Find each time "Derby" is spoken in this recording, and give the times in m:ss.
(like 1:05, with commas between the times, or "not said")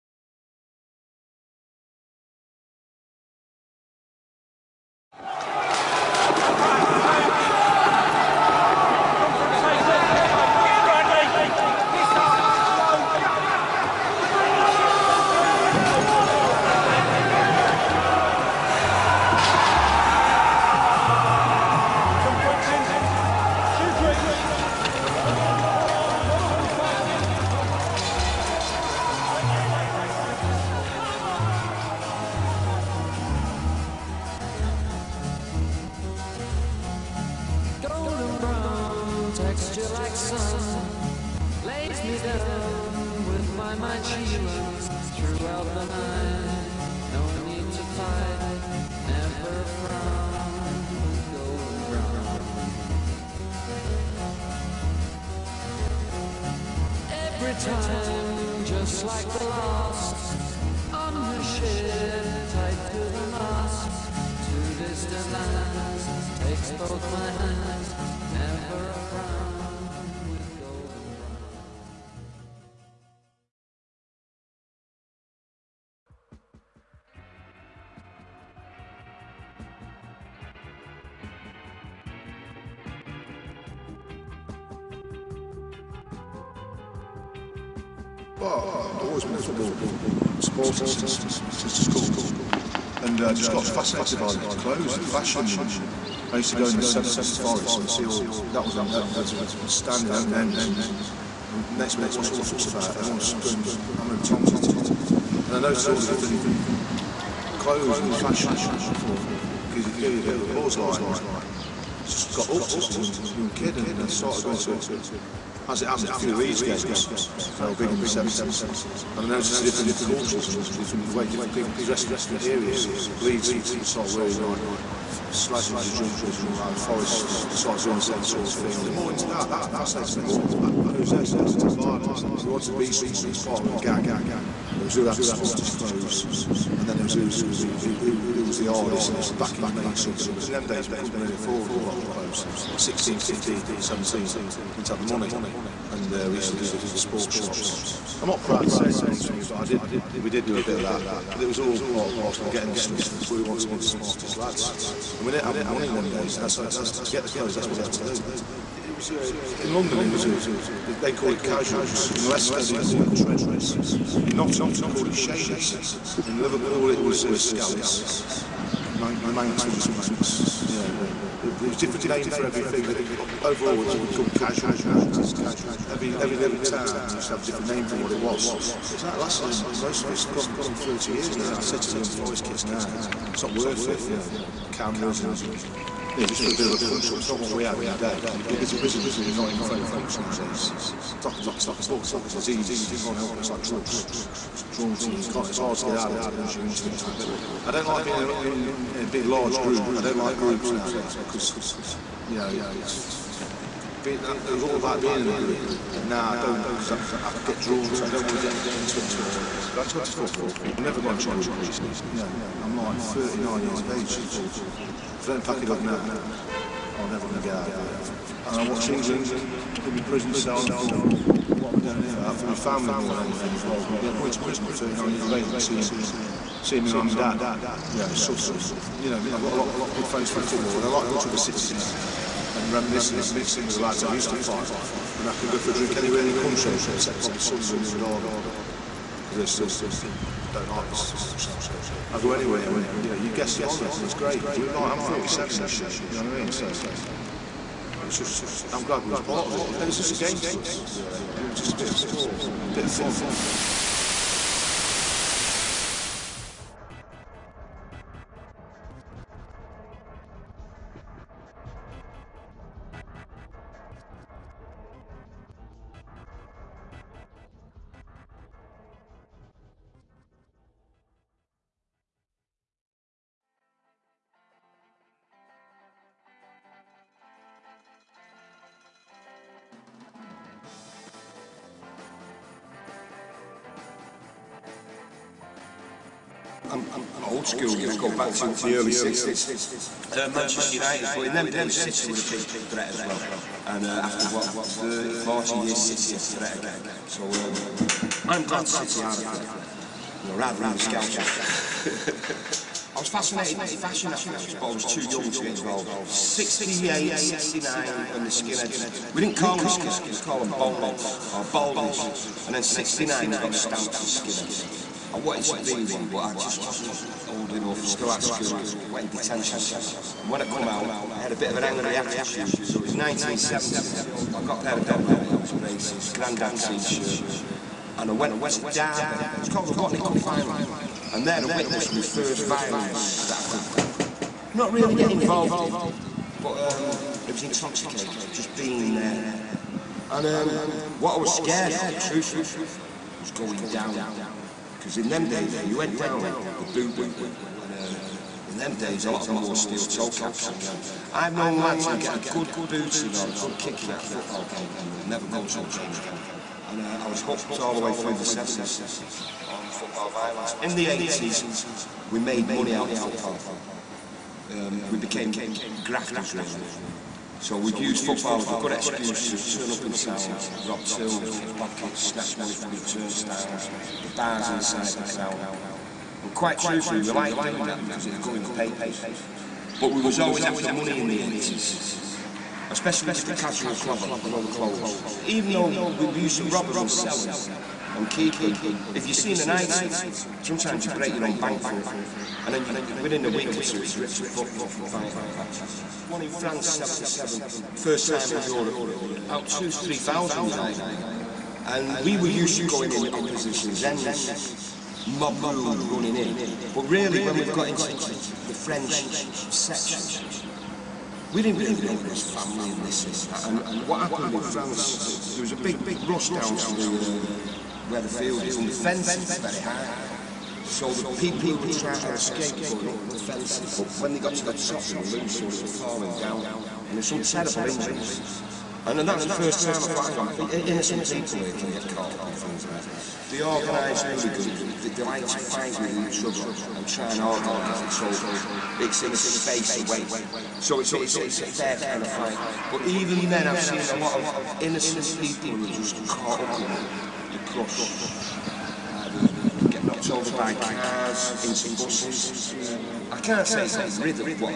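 3:57, 5:28.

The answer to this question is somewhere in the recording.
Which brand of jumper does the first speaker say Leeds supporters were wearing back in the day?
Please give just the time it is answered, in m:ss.
2:05.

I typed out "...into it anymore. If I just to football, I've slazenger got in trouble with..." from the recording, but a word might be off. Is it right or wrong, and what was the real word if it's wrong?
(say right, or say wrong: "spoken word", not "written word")
wrong: "never", not "slazenger".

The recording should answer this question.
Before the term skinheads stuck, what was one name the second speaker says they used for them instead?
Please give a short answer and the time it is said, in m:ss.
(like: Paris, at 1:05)
Boneheads, at 5:10.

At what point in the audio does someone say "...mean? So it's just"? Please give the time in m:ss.
4:06.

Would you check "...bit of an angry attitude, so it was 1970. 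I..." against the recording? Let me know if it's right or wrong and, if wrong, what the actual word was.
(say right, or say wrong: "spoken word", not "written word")
right.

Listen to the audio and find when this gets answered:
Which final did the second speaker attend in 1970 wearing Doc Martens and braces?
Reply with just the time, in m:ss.
5:29.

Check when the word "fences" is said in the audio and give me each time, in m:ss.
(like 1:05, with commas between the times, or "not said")
6:58, 7:03.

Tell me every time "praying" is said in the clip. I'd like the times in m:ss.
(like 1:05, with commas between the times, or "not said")
not said.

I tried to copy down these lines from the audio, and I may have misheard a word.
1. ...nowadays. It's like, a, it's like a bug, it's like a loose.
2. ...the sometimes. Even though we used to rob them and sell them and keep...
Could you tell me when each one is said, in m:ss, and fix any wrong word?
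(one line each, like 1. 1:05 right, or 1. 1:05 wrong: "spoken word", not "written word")
1. 3:10 wrong: "disease", not "loose"
2. 6:24 wrong: "clothes", not "sometimes".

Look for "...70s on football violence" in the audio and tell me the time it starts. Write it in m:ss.
5:58.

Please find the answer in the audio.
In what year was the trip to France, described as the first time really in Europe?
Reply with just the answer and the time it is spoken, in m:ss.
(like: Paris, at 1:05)
1977, at 6:36.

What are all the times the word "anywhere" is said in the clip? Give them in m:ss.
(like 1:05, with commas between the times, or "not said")
3:55, 4:02.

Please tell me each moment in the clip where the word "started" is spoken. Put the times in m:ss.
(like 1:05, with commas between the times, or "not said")
1:54.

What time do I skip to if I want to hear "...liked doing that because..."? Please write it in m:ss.
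6:17.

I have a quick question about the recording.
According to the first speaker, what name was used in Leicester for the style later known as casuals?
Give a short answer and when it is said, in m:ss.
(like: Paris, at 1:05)
Trendies, at 2:43.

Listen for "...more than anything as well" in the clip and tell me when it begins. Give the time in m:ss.
3:42.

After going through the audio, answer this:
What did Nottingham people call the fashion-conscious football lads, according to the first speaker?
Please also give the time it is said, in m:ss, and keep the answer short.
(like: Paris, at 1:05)
Shadies, at 2:45.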